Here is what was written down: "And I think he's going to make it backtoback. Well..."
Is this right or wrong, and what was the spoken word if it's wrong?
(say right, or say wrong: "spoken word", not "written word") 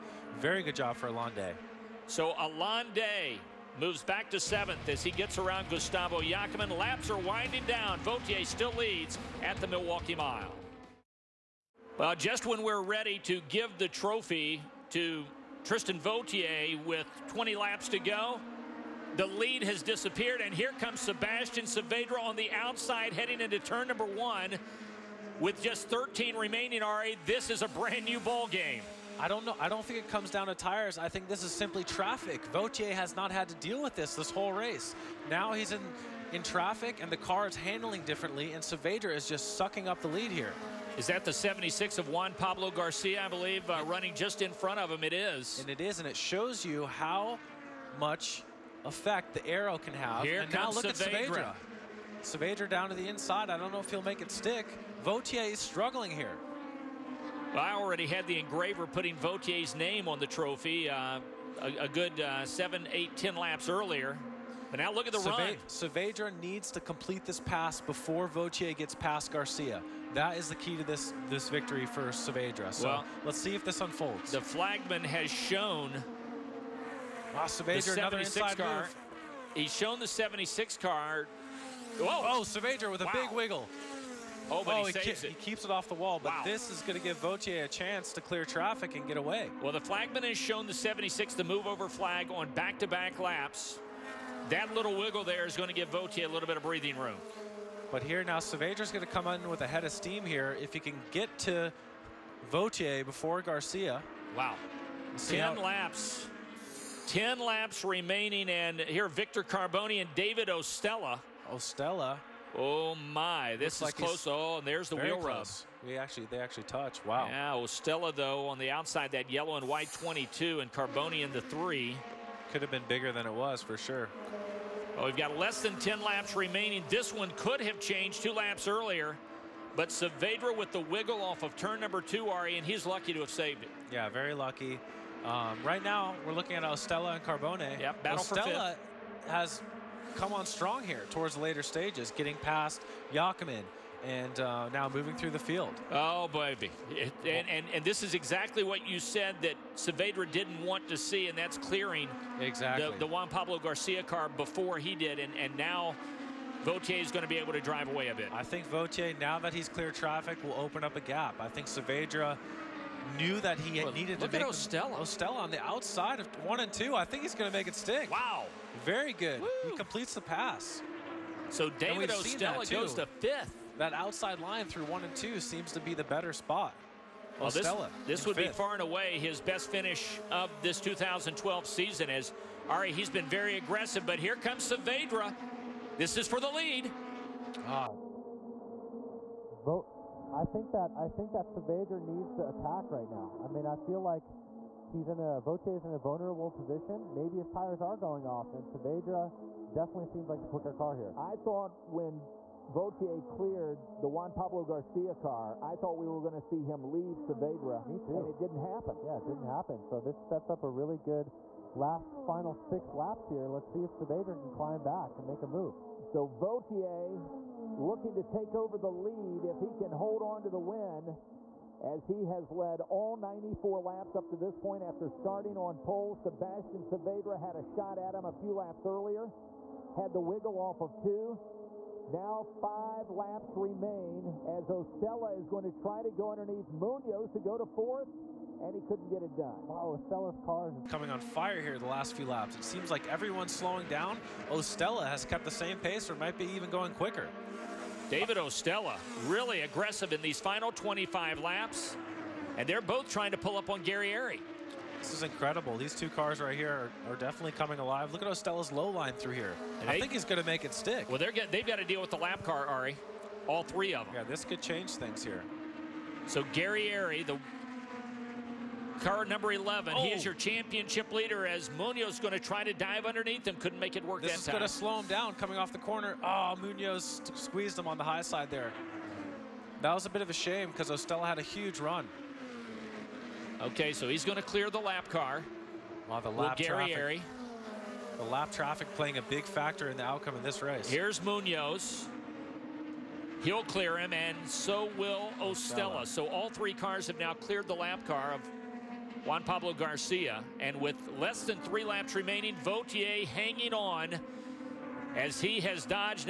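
wrong: "stick", not "backtoback".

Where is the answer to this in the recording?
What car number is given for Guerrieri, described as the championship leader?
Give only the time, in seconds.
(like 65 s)
269 s.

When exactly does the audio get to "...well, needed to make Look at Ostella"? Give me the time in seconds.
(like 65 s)
163 s.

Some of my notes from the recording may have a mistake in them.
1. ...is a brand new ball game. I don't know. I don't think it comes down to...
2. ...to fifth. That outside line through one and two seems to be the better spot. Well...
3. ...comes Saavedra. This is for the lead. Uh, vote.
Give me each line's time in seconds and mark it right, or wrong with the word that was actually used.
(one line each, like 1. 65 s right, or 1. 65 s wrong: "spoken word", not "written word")
1. 27 s right
2. 172 s right
3. 184 s right.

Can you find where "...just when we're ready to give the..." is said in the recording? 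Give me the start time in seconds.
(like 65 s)
12 s.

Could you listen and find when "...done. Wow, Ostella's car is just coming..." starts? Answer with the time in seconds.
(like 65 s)
239 s.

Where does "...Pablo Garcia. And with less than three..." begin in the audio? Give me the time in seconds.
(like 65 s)
299 s.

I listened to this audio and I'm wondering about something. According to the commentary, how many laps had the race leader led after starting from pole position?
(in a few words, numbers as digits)
94.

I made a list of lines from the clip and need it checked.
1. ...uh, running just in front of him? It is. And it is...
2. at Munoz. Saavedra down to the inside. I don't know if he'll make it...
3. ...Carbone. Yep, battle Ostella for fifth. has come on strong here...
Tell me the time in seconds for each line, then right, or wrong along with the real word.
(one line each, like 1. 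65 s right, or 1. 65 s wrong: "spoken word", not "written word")
1. 43 s right
2. 51 s wrong: "Saavedra", not "Munoz"
3. 137 s right.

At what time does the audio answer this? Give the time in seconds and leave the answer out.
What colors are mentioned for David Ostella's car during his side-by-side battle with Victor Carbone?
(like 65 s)
119 s.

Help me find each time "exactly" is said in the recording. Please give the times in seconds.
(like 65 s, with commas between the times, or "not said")
148 s, 152 s.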